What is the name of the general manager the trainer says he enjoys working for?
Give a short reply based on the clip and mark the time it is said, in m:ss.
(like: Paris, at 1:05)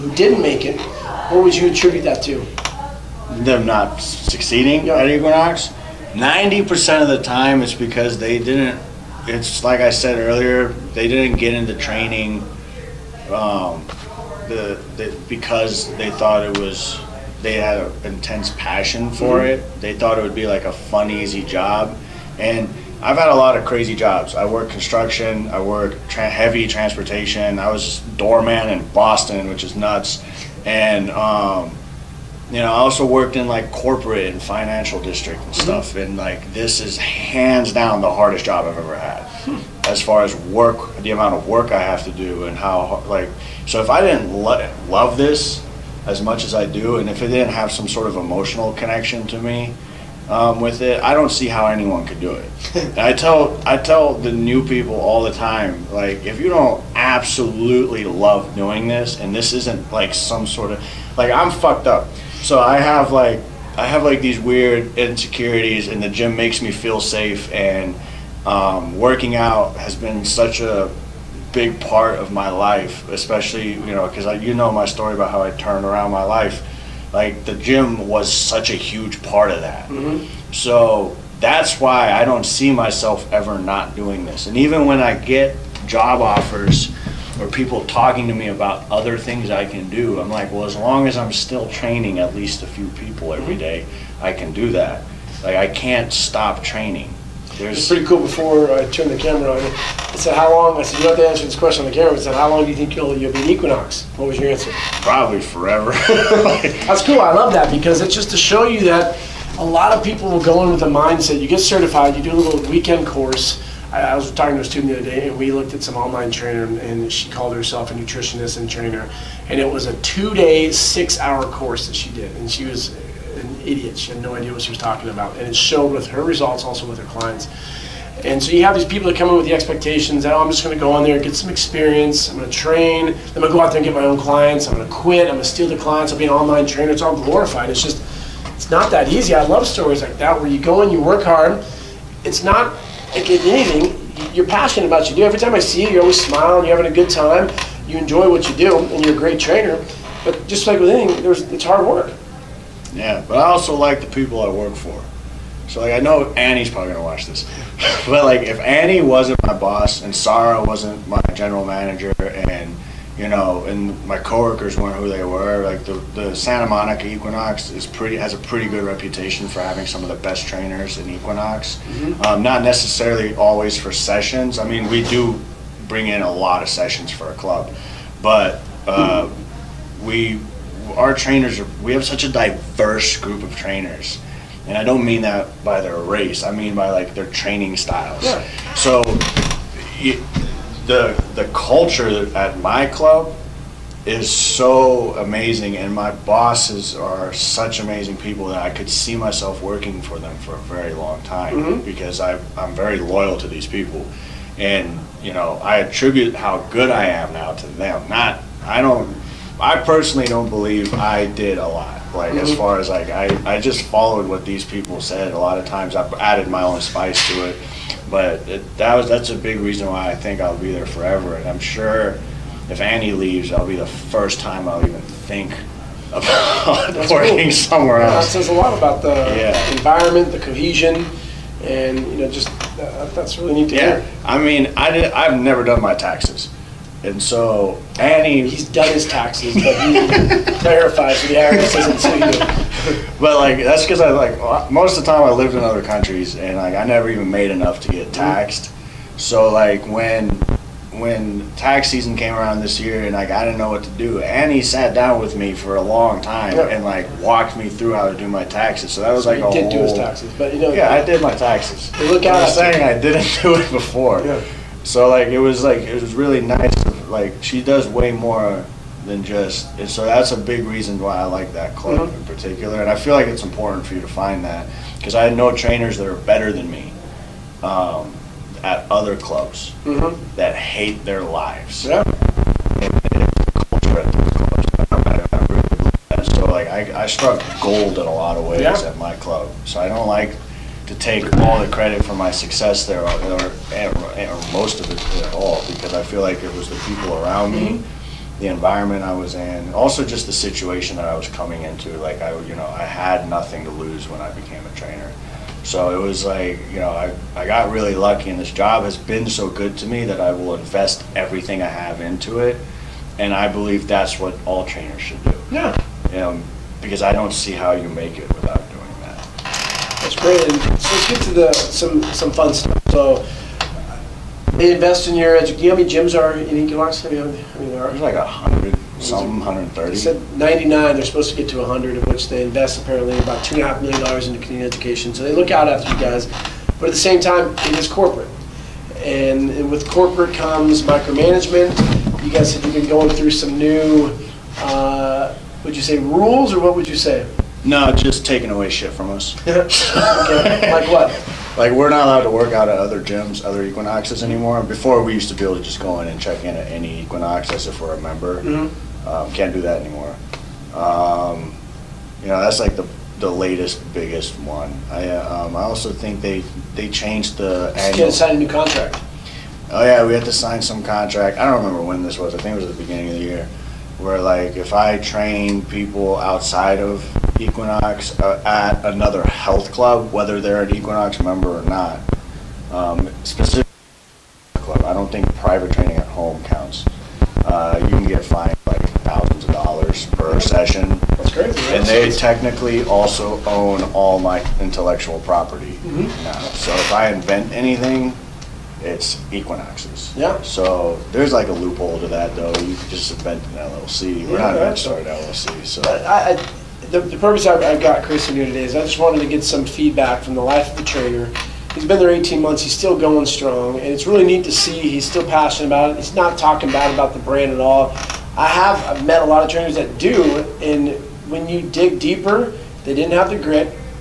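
Sarah, at 2:40.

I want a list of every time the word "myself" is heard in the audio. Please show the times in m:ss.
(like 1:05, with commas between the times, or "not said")
1:22, 3:19.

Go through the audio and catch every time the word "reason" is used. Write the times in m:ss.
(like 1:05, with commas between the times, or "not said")
3:39, 4:30.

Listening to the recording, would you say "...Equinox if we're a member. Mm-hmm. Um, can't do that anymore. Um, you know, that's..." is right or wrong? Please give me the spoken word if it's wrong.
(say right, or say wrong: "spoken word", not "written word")
right.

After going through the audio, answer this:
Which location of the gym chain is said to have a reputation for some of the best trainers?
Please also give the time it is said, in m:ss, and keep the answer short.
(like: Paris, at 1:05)
Santa Monica, at 2:46.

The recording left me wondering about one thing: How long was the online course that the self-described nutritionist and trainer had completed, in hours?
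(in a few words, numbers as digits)
6 hours.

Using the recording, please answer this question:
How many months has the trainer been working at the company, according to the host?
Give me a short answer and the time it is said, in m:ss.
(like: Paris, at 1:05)
18 months, at 6:52.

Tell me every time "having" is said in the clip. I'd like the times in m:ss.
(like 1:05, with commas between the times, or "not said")
2:26, 2:49.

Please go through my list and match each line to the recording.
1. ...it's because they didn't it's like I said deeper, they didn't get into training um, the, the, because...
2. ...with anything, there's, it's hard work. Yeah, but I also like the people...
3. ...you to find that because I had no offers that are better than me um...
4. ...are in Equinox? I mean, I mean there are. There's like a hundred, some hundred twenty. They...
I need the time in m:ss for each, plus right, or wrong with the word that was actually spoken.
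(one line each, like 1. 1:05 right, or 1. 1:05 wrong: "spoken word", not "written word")
1. 0:07 wrong: "earlier", not "deeper"
2. 2:30 right
3. 4:33 wrong: "trainers", not "offers"
4. 5:26 wrong: "thirty", not "twenty".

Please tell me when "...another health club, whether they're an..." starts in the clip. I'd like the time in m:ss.
6:18.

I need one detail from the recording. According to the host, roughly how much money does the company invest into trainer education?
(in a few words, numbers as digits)
$2.5 million.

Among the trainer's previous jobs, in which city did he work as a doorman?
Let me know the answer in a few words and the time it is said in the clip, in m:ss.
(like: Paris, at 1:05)
Boston, at 0:28.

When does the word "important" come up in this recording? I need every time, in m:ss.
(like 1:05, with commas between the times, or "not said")
4:33.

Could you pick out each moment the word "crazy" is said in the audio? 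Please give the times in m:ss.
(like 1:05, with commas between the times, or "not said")
0:23, 6:31.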